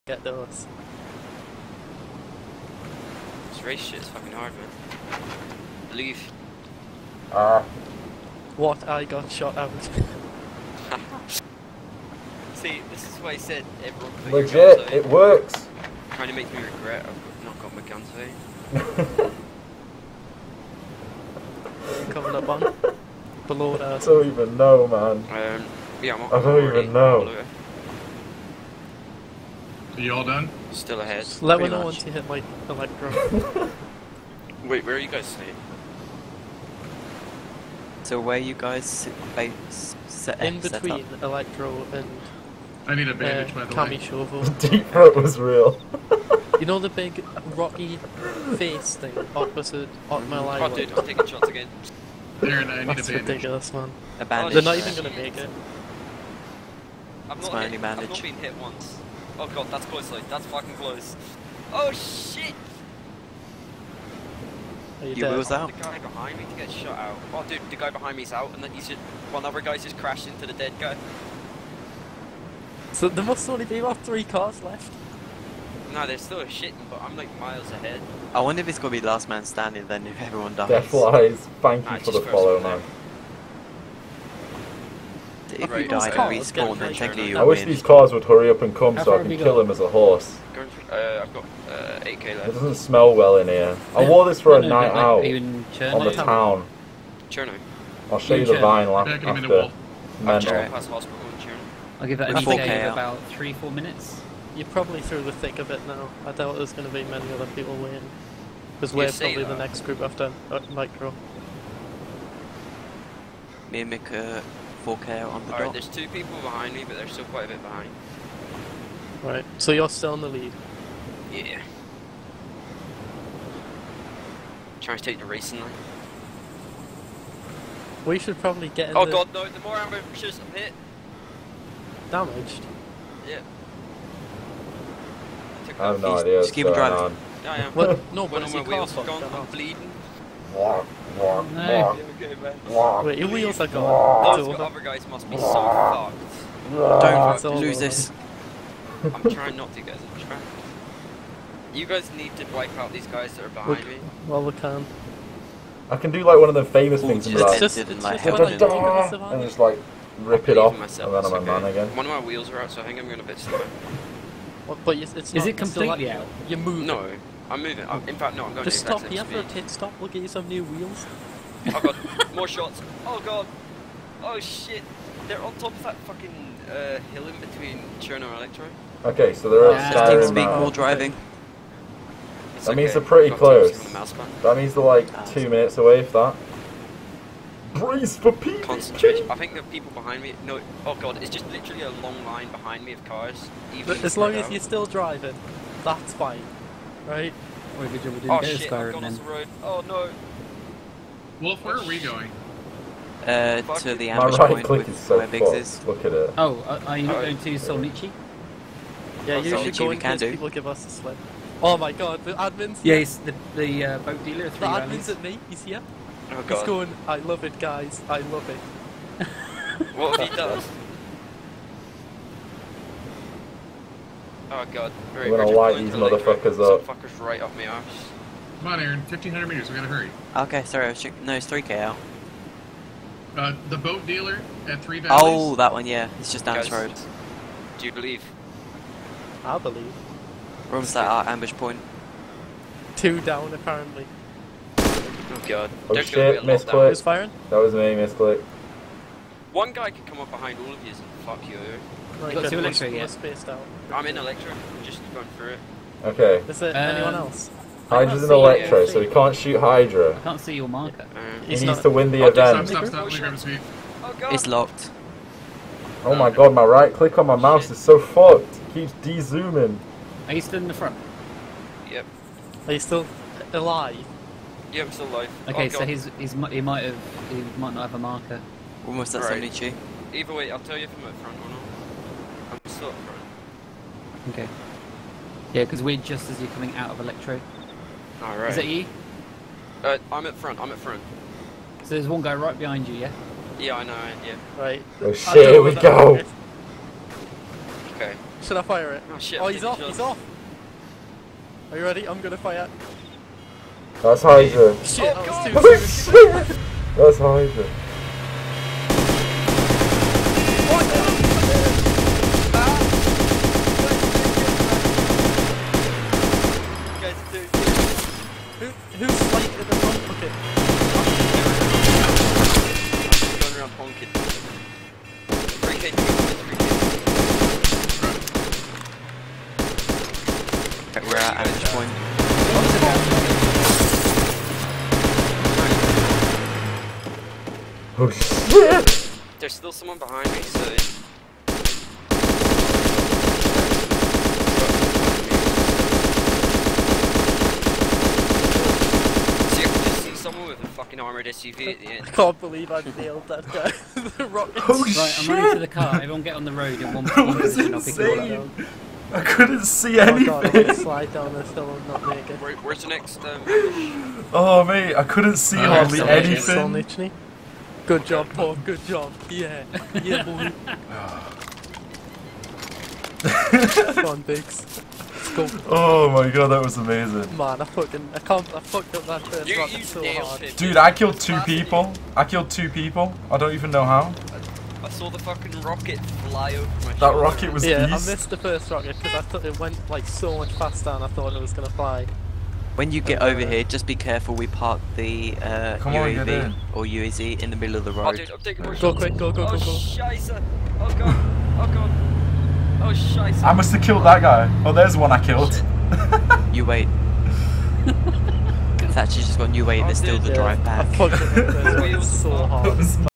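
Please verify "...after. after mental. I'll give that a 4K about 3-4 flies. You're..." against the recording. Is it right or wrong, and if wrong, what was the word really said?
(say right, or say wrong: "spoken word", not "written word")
wrong: "minutes", not "flies".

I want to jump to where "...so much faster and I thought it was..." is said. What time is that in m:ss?
6:30.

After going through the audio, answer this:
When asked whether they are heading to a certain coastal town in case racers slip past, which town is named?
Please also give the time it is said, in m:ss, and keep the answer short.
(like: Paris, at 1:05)
Solnichi, at 3:27.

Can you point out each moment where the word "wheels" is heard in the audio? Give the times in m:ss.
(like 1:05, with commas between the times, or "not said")
2:23, 2:42, 2:50.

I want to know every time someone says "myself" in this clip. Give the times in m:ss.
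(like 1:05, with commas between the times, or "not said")
2:40.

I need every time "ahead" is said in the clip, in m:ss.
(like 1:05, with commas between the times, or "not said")
0:31, 1:17.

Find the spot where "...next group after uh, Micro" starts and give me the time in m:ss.
1:49.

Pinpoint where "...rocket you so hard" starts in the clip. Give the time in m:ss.
6:19.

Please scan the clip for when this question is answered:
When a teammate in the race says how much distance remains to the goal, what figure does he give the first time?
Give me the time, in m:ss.
1:32.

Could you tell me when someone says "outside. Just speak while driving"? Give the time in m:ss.
2:59.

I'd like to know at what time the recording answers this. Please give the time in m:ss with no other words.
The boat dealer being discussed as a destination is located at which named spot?
3:54.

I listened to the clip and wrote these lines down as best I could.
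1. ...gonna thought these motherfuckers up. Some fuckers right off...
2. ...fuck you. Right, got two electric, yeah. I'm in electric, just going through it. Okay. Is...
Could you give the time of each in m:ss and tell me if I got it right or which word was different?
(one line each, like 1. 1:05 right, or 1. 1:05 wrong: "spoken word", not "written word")
1. 3:45 wrong: "light", not "thought"
2. 4:11 right.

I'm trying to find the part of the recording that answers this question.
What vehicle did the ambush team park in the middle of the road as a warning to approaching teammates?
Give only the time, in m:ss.
6:36.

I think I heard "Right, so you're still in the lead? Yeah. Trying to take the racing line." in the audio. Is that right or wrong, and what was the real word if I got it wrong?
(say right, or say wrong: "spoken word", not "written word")
right.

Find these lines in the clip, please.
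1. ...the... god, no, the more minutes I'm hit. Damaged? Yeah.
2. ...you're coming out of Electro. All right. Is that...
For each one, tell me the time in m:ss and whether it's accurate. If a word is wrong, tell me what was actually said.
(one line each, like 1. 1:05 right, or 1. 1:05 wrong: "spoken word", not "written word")
1. 2:09 wrong: "ambushes", not "minutes"
2. 4:46 right.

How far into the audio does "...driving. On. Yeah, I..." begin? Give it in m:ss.
2:16.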